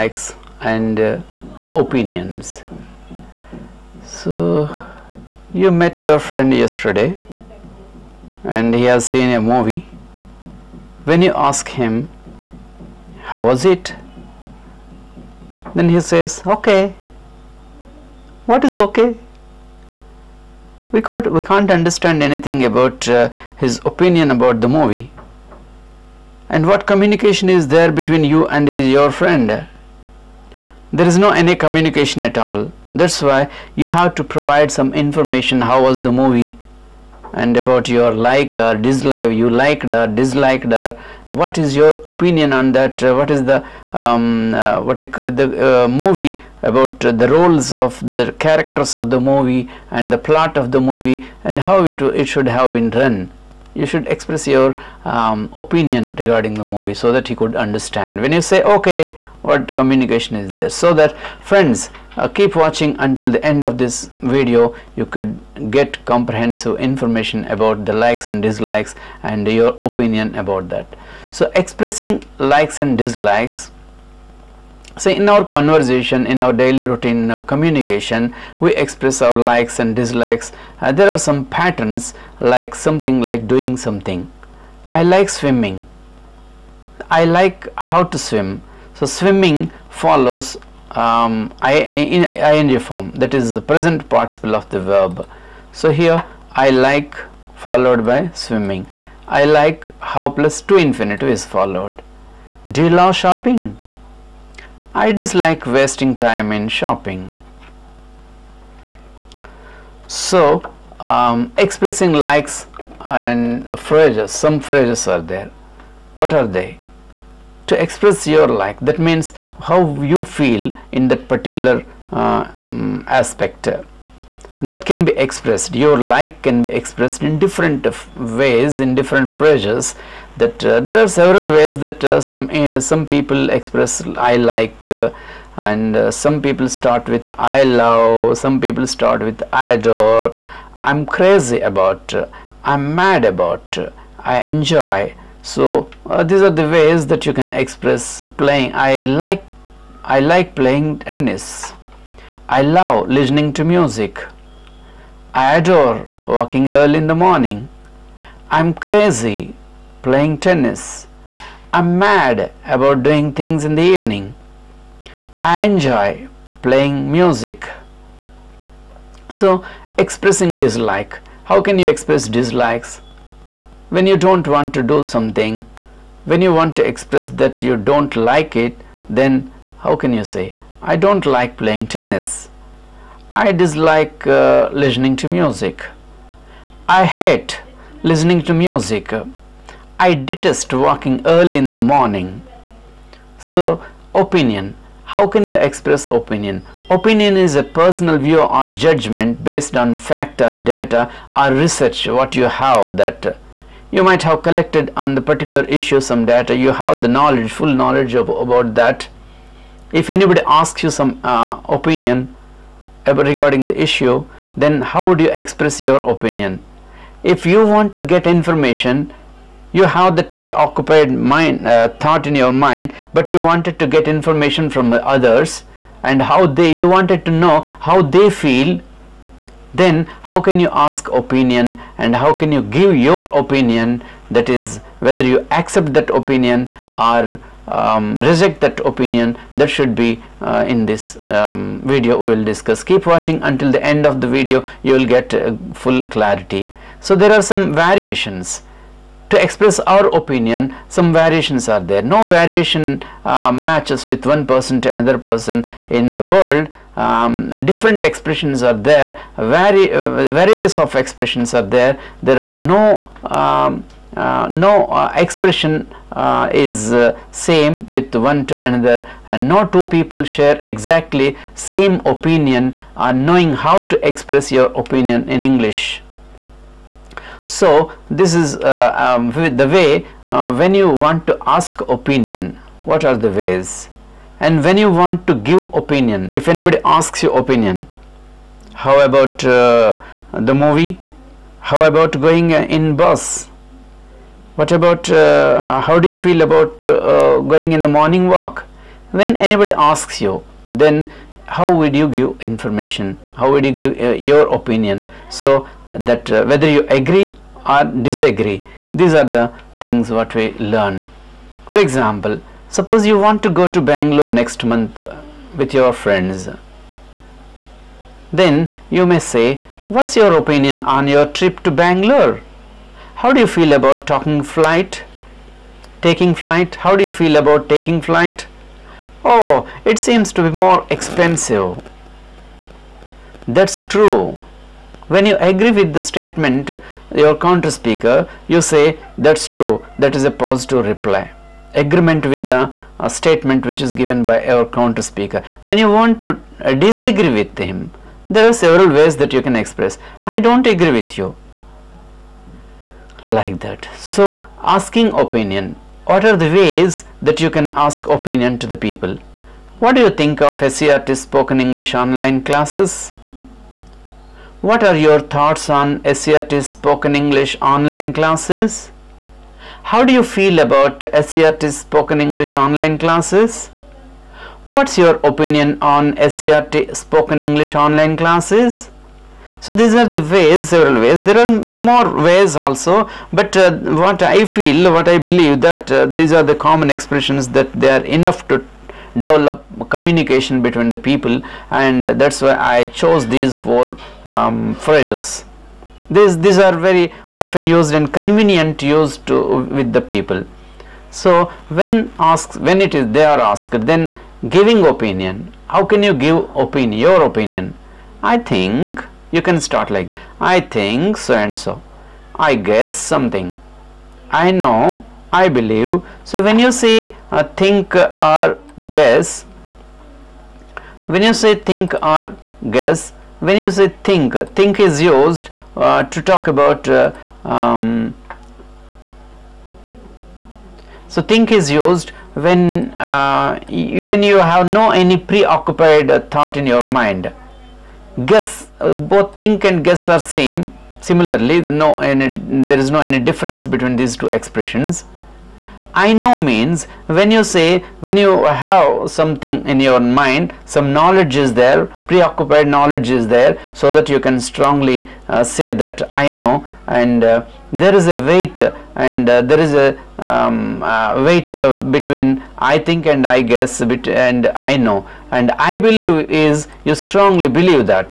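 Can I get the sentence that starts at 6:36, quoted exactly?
These, these are very often used and convenient used to, with the people.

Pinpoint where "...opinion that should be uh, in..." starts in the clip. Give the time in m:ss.
3:58.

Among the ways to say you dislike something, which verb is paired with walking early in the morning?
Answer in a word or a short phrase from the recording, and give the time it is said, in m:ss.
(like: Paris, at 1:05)
Detest, at 3:09.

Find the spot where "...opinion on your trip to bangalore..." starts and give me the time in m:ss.
5:20.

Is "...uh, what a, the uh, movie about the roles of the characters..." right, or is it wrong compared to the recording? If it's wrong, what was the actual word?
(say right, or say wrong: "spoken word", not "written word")
right.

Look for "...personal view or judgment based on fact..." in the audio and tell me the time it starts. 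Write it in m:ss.
3:17.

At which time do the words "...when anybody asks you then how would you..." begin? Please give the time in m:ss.
4:59.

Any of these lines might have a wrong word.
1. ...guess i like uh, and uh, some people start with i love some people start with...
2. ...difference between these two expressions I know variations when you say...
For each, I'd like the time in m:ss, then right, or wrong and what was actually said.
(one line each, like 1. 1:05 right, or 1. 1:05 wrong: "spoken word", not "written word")
1. 2:13 wrong: "express", not "guess"
2. 7:23 wrong: "means", not "variations".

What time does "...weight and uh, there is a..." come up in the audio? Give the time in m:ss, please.
7:38.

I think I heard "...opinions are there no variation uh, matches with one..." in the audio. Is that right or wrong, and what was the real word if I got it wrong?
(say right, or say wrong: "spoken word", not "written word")
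wrong: "variations", not "opinions".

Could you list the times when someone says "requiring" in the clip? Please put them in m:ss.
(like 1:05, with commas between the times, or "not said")
not said.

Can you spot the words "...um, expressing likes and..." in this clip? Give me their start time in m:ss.
1:50.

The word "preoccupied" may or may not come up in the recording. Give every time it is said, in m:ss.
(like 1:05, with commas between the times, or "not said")
3:40, 7:15, 7:32.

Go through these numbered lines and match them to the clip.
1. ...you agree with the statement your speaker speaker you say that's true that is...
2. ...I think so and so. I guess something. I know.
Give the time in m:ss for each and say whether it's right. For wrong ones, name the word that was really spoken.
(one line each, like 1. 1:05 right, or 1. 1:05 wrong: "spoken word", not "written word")
1. 5:35 wrong: "counter", not "speaker"
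2. 6:50 right.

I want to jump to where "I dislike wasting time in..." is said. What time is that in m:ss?
1:44.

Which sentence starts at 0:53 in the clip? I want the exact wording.
You should express your um, opinion regarding the movie so that he could understand.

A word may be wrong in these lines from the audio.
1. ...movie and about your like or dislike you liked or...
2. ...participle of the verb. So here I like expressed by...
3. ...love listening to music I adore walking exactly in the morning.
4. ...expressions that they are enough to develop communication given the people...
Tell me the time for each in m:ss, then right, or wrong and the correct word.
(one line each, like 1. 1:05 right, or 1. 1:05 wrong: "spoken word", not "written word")
1. 0:36 right
2. 1:34 wrong: "followed", not "expressed"
3. 2:32 wrong: "early", not "exactly"
4. 6:26 wrong: "between", not "given".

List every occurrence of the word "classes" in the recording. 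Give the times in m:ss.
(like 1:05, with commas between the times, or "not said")
6:02, 6:08, 6:12, 6:18.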